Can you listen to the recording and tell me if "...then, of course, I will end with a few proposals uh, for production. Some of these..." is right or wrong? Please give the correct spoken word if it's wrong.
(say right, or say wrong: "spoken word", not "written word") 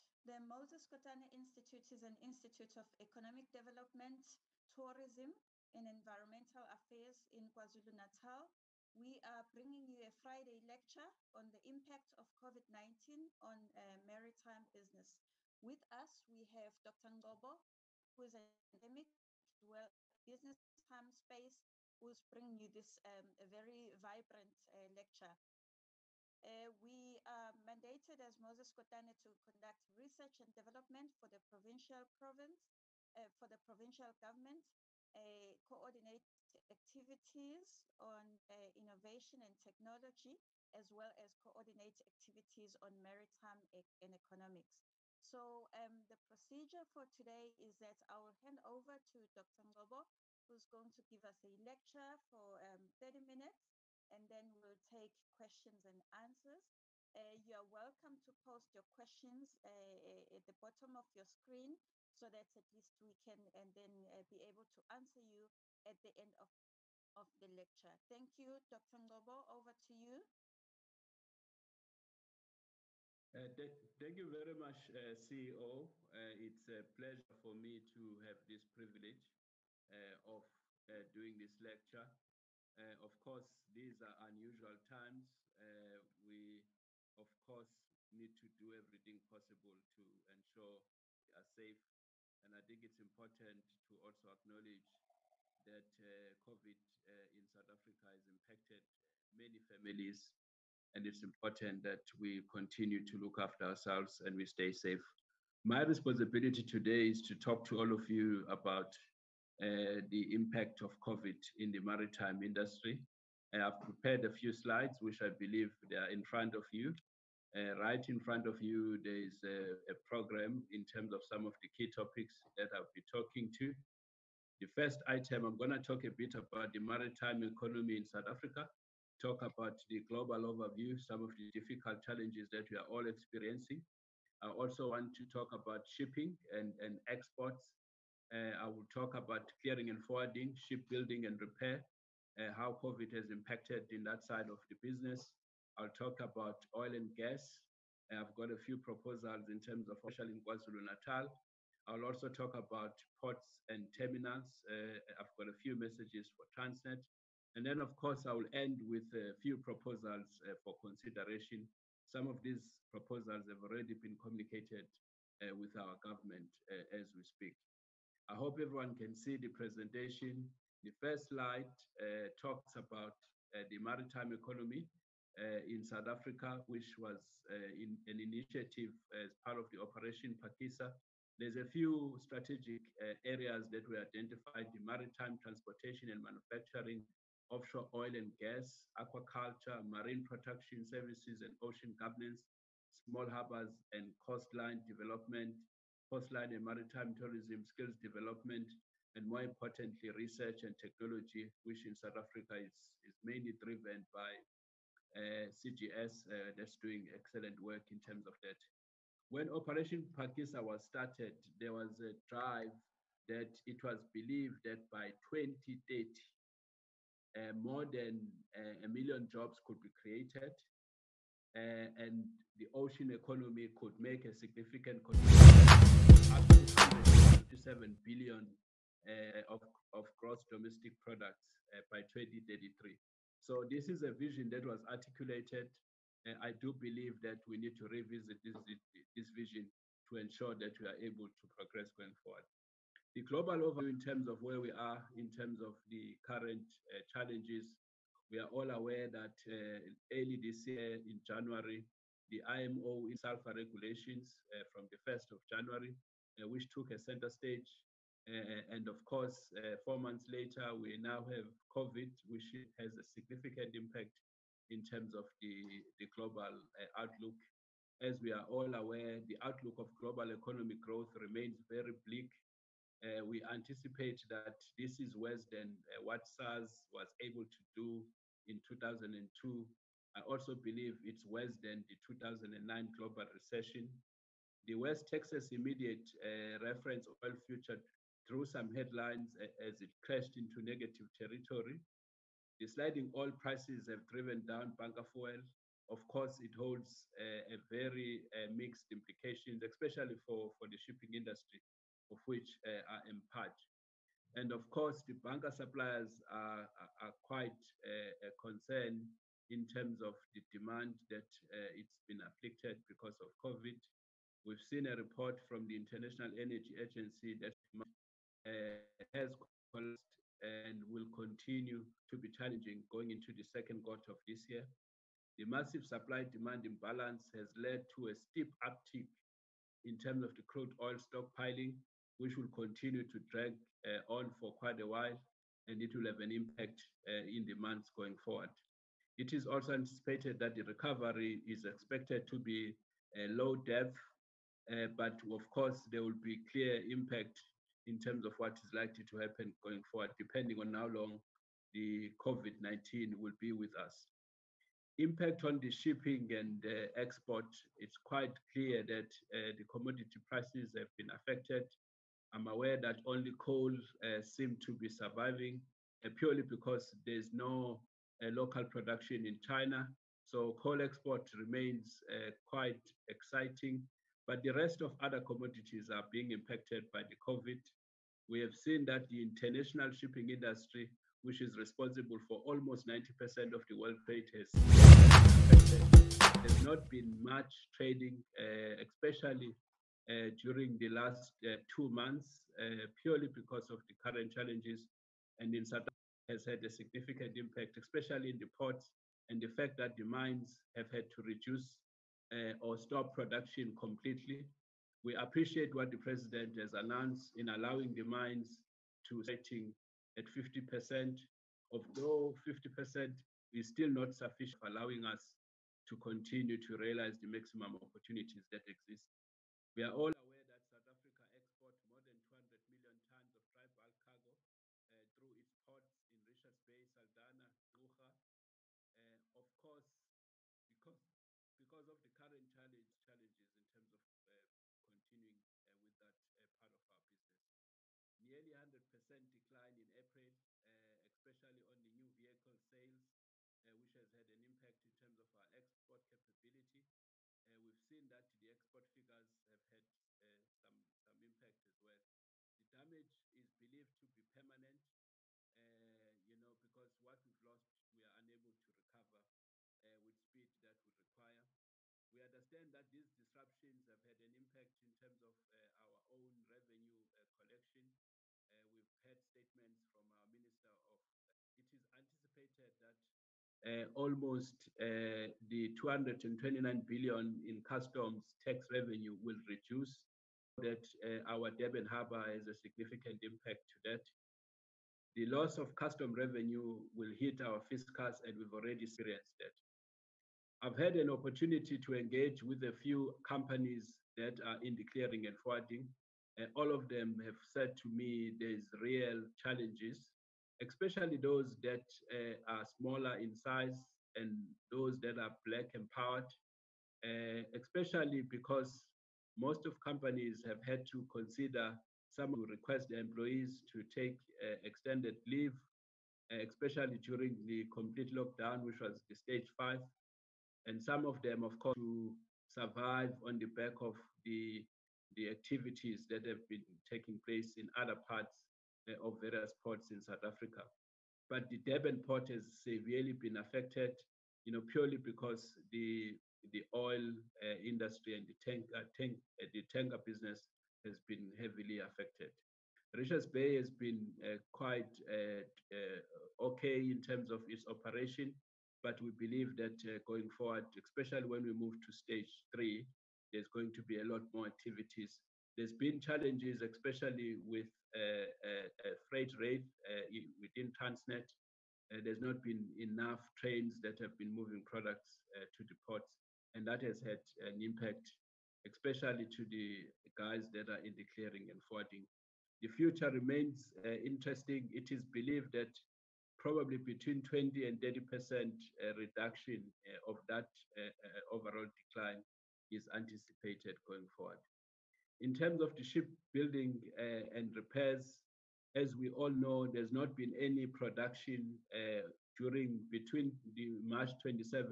wrong: "consideration", not "production".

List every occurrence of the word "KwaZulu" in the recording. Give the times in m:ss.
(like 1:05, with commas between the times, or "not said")
0:07, 2:30.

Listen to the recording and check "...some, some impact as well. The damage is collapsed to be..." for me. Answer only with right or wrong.
wrong.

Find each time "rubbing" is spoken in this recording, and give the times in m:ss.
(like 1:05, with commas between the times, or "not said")
not said.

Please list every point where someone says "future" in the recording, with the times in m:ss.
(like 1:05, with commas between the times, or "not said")
4:47, 9:32.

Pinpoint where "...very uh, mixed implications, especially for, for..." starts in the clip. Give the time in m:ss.
4:57.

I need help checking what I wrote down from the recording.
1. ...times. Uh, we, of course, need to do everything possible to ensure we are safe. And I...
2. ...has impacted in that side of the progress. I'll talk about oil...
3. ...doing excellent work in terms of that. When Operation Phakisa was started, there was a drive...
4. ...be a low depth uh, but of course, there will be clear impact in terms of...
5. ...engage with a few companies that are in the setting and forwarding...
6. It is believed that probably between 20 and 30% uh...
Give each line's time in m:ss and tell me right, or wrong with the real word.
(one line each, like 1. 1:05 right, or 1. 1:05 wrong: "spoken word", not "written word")
1. 1:24 right
2. 2:23 wrong: "business", not "progress"
3. 3:26 right
4. 5:42 right
5. 8:11 wrong: "clearing", not "setting"
6. 9:34 right.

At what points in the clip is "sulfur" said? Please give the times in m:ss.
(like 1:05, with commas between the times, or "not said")
4:13.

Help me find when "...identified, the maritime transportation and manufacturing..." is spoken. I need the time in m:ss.
3:03.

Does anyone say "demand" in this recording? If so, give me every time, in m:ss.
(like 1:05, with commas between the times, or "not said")
5:10, 5:26.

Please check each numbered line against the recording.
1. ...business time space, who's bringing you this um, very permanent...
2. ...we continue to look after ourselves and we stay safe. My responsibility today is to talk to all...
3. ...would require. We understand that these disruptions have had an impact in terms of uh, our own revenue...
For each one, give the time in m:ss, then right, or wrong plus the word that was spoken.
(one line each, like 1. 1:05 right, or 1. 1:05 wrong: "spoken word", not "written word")
1. 0:20 wrong: "vibrant", not "permanent"
2. 1:42 right
3. 7:40 right.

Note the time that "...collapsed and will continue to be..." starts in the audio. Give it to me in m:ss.
5:19.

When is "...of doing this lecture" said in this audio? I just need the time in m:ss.
1:20.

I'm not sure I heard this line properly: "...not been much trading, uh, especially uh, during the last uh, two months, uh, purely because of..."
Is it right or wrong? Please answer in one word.
right.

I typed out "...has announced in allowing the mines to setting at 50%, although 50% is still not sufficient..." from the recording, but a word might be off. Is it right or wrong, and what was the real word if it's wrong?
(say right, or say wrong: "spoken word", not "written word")
right.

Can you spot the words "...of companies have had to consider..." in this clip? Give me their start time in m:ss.
8:29.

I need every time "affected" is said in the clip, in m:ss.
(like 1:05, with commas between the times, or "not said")
6:01, 8:53, 9:01.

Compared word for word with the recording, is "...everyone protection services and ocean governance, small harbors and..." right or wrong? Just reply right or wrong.
wrong.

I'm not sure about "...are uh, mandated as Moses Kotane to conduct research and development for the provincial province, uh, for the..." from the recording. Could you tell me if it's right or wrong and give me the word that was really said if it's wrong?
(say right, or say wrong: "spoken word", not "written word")
right.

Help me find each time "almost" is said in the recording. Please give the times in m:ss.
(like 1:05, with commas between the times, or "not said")
6:22, 7:53.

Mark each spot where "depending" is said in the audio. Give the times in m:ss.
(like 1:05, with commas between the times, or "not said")
5:50.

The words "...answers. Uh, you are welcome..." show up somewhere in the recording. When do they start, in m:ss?
0:56.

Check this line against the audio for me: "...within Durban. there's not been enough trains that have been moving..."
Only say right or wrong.
wrong.